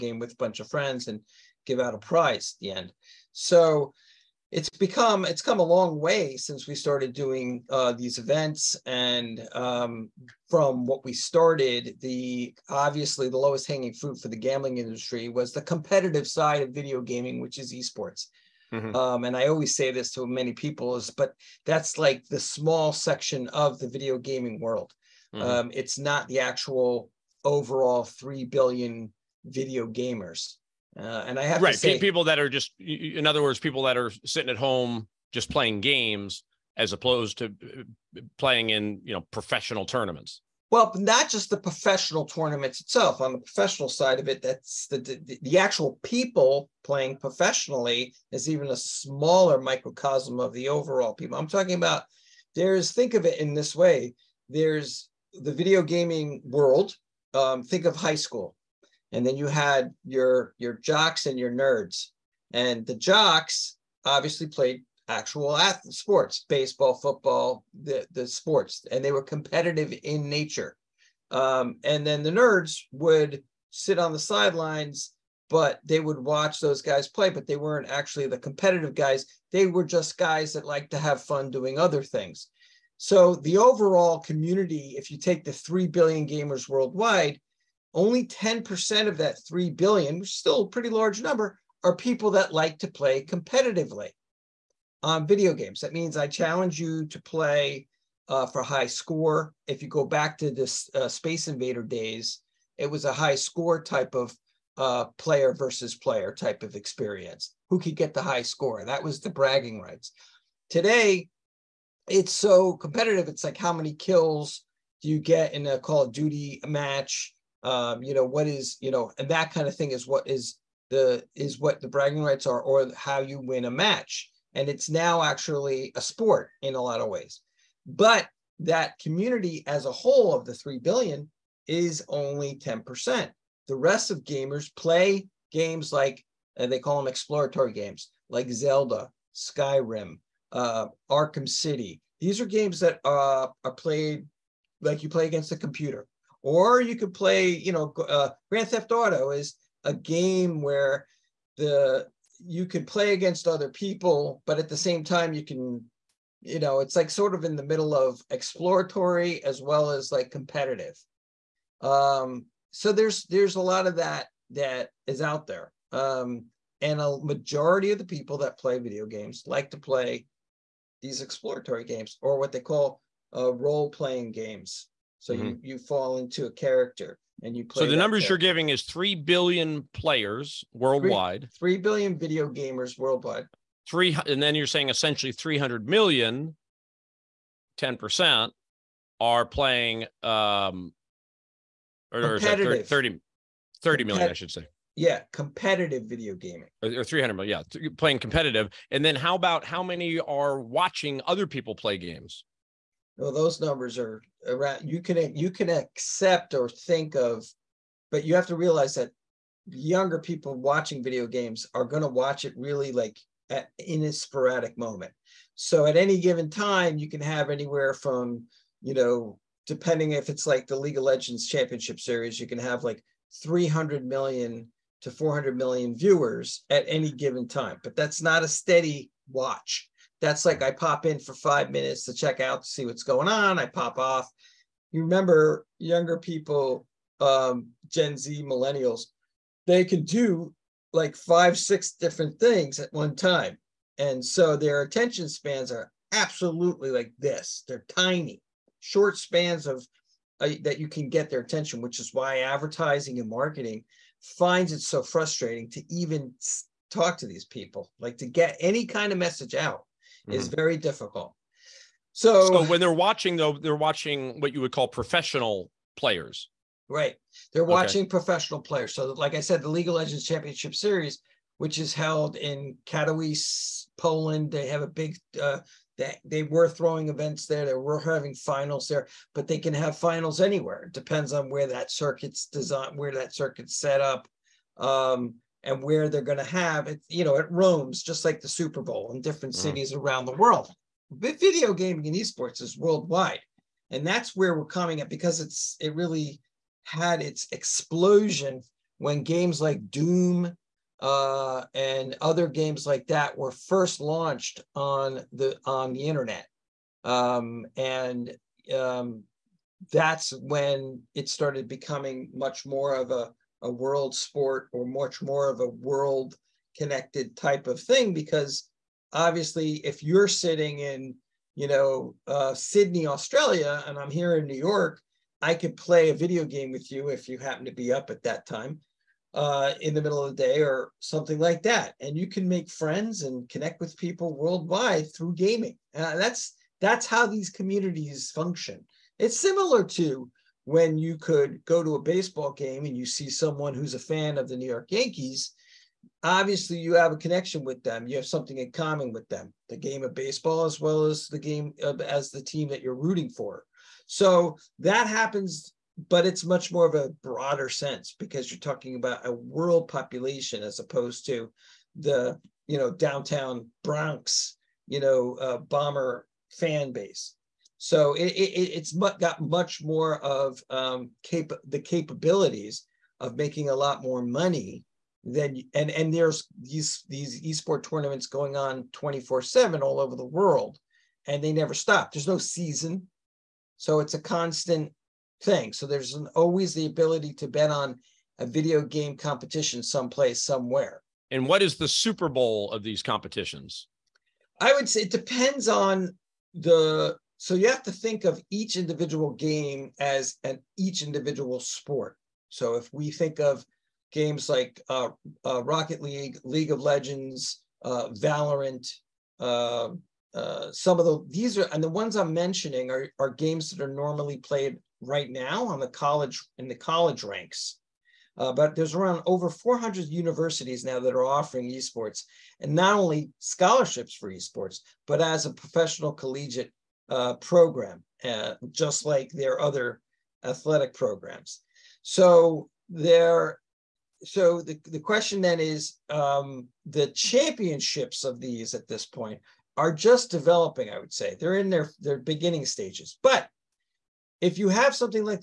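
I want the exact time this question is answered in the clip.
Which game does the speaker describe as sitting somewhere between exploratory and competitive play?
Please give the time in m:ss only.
2:28.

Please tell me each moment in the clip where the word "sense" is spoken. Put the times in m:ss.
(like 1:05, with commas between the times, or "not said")
5:57.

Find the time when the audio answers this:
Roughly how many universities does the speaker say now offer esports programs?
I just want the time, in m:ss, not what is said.
6:59.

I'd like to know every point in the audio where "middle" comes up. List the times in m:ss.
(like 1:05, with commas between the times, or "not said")
2:37, 5:30.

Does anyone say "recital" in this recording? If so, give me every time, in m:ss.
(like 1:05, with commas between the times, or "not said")
not said.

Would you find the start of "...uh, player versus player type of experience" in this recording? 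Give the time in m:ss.
1:44.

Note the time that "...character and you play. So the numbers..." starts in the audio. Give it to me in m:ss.
2:56.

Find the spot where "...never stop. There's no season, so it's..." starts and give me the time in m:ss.
6:21.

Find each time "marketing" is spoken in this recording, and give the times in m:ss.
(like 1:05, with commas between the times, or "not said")
4:13.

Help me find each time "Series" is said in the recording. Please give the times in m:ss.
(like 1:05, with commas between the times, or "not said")
3:42, 4:30.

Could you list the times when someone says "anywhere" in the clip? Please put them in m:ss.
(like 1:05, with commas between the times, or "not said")
3:37, 4:40.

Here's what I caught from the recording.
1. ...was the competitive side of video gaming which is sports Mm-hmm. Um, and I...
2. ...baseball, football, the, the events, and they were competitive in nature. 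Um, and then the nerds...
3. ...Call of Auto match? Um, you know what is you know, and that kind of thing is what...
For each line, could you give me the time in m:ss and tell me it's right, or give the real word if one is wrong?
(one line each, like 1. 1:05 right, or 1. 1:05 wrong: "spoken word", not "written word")
1. 0:15 wrong: "esports", not "sports"
2. 1:06 wrong: "sports", not "events"
3. 1:55 wrong: "Duty", not "Auto".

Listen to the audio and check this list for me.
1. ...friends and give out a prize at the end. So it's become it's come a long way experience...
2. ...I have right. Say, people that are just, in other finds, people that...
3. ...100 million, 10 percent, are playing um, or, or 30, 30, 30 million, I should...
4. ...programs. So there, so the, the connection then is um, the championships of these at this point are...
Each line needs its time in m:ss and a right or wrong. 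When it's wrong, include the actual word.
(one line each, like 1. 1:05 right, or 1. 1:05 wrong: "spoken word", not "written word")
1. 0:00 wrong: "since", not "experience"
2. 0:31 wrong: "words", not "finds"
3. 3:05 wrong: "300", not "100"
4. 7:10 wrong: "question", not "connection".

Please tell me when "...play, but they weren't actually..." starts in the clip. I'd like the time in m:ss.
1:17.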